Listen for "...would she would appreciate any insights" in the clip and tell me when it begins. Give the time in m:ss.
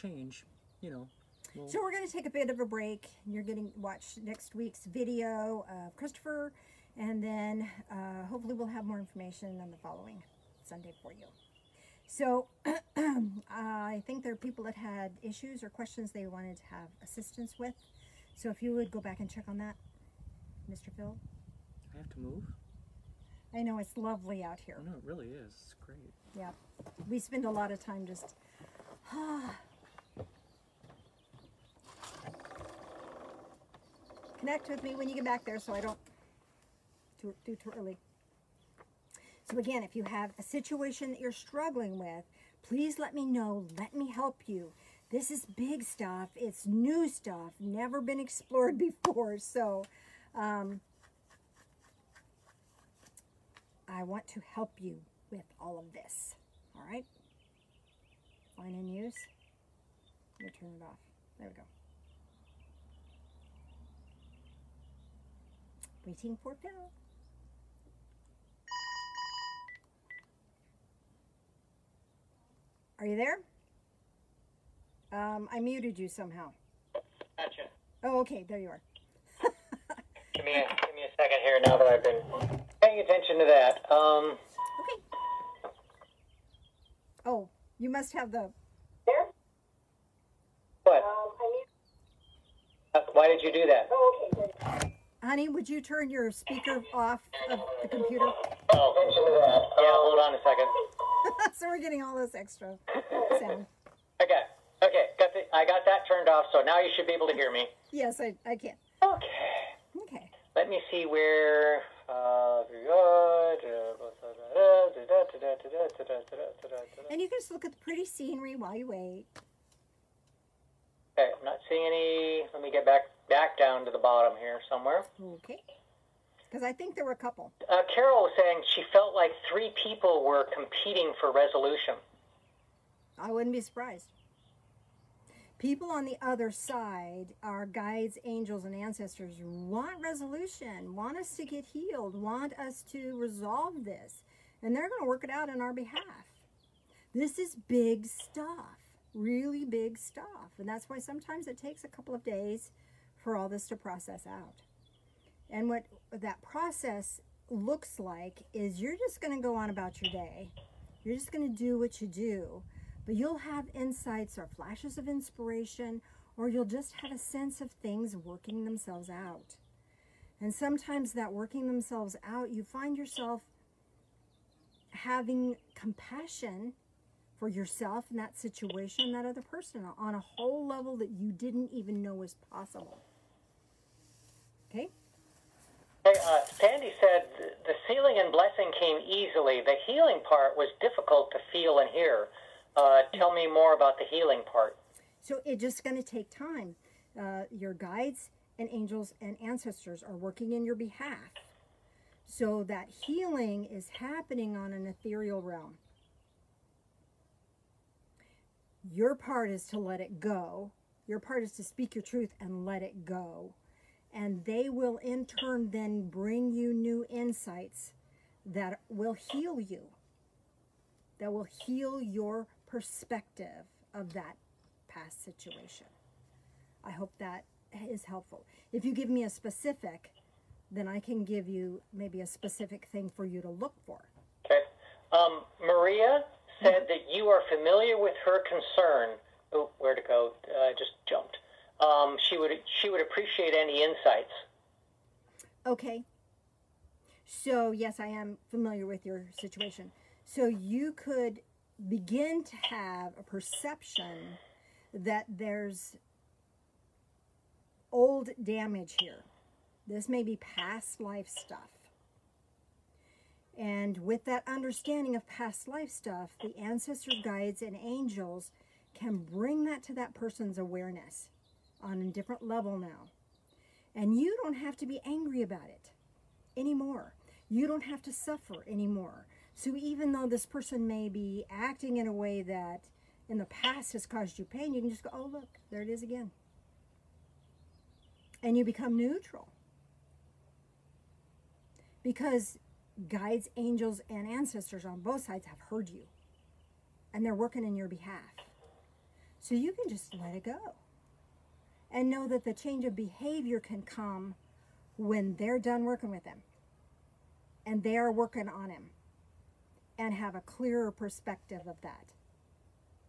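4:02.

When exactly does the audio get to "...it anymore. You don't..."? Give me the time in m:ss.
4:35.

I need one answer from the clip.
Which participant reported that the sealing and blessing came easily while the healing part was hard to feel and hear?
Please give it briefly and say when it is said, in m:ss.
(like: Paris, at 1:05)
Sandy, at 3:06.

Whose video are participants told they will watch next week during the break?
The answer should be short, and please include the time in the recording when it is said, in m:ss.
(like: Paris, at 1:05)
Christopher, at 0:05.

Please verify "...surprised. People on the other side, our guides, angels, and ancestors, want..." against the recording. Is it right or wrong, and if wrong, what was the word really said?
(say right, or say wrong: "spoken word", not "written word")
right.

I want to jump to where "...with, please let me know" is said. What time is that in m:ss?
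0:41.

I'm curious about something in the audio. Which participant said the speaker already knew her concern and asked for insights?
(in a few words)
Maria.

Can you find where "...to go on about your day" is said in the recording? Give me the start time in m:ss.
2:39.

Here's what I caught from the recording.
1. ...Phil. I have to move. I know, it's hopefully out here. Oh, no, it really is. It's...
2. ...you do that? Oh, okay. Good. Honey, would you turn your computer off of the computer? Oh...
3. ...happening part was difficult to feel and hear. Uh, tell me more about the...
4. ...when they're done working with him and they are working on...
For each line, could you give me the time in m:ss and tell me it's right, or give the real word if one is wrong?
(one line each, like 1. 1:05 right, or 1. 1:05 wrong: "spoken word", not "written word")
1. 0:20 wrong: "lovely", not "hopefully"
2. 1:33 wrong: "speaker", not "computer"
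3. 3:09 wrong: "healing", not "happening"
4. 5:04 right.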